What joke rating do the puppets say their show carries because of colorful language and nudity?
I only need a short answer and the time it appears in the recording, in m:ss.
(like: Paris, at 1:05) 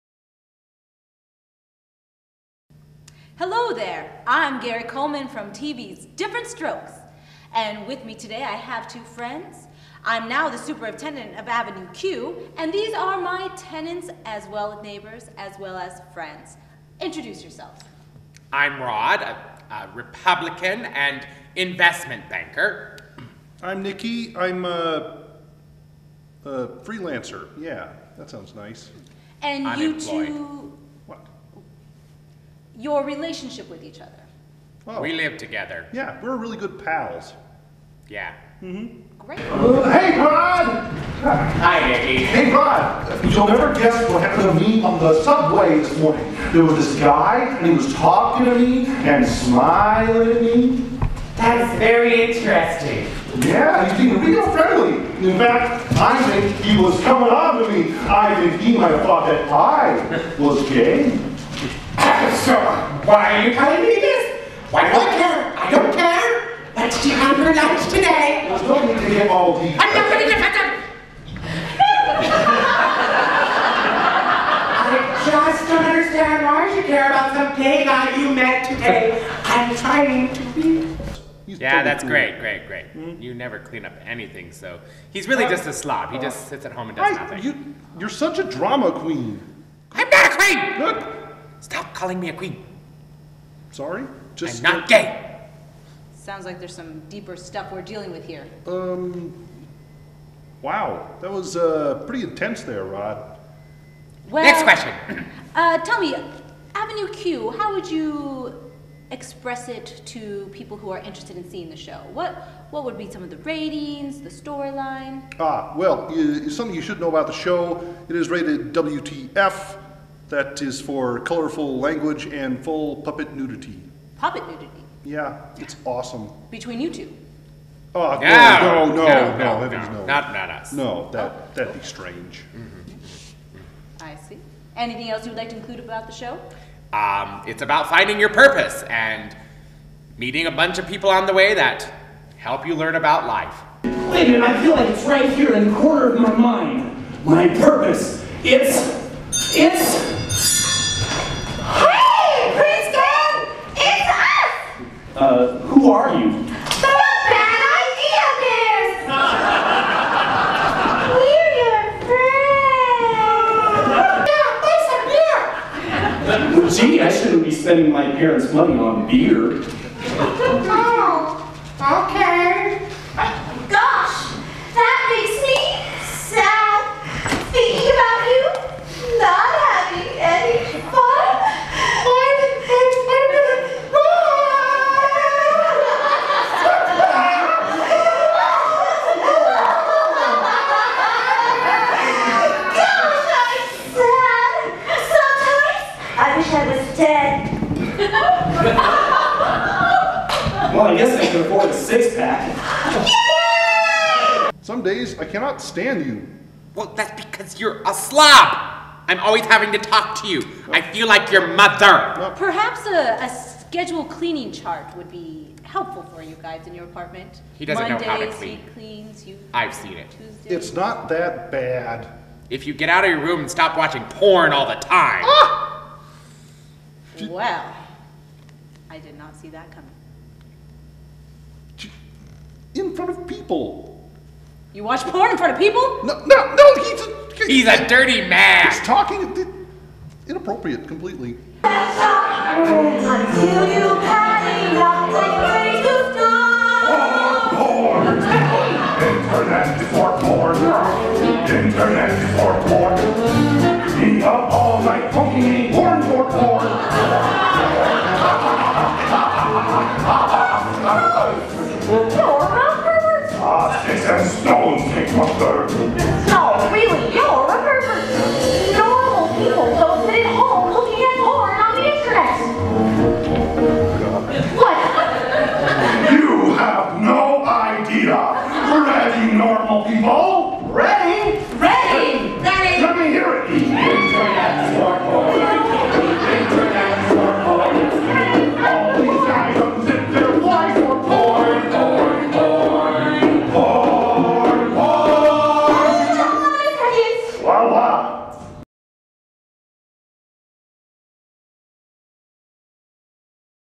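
WTF, at 1:58.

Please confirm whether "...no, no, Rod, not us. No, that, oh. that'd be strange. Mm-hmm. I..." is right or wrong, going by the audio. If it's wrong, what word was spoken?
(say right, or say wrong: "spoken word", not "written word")
wrong: "Not", not "Rod".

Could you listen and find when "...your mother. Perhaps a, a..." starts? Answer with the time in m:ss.
3:31.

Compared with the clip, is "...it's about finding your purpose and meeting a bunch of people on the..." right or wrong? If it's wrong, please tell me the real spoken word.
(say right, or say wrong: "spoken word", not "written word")
right.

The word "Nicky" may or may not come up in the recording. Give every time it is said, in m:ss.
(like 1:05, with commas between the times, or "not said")
0:23, 0:41.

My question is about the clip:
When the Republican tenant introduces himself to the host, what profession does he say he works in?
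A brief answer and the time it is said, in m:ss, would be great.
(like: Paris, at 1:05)
Investment banker, at 0:21.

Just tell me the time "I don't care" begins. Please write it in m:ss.
1:05.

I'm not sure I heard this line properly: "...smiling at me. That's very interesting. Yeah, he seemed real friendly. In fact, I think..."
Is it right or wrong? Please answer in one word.
right.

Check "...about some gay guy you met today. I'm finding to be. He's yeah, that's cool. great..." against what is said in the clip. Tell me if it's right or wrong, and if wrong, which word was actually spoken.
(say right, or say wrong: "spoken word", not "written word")
wrong: "trying", not "finding".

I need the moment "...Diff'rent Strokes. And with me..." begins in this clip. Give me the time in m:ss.
0:06.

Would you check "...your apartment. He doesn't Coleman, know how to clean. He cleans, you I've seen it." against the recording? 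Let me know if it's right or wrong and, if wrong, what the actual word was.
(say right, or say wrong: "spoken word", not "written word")
wrong: "Mondays", not "Coleman".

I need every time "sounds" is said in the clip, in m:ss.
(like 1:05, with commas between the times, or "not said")
0:28, 1:36.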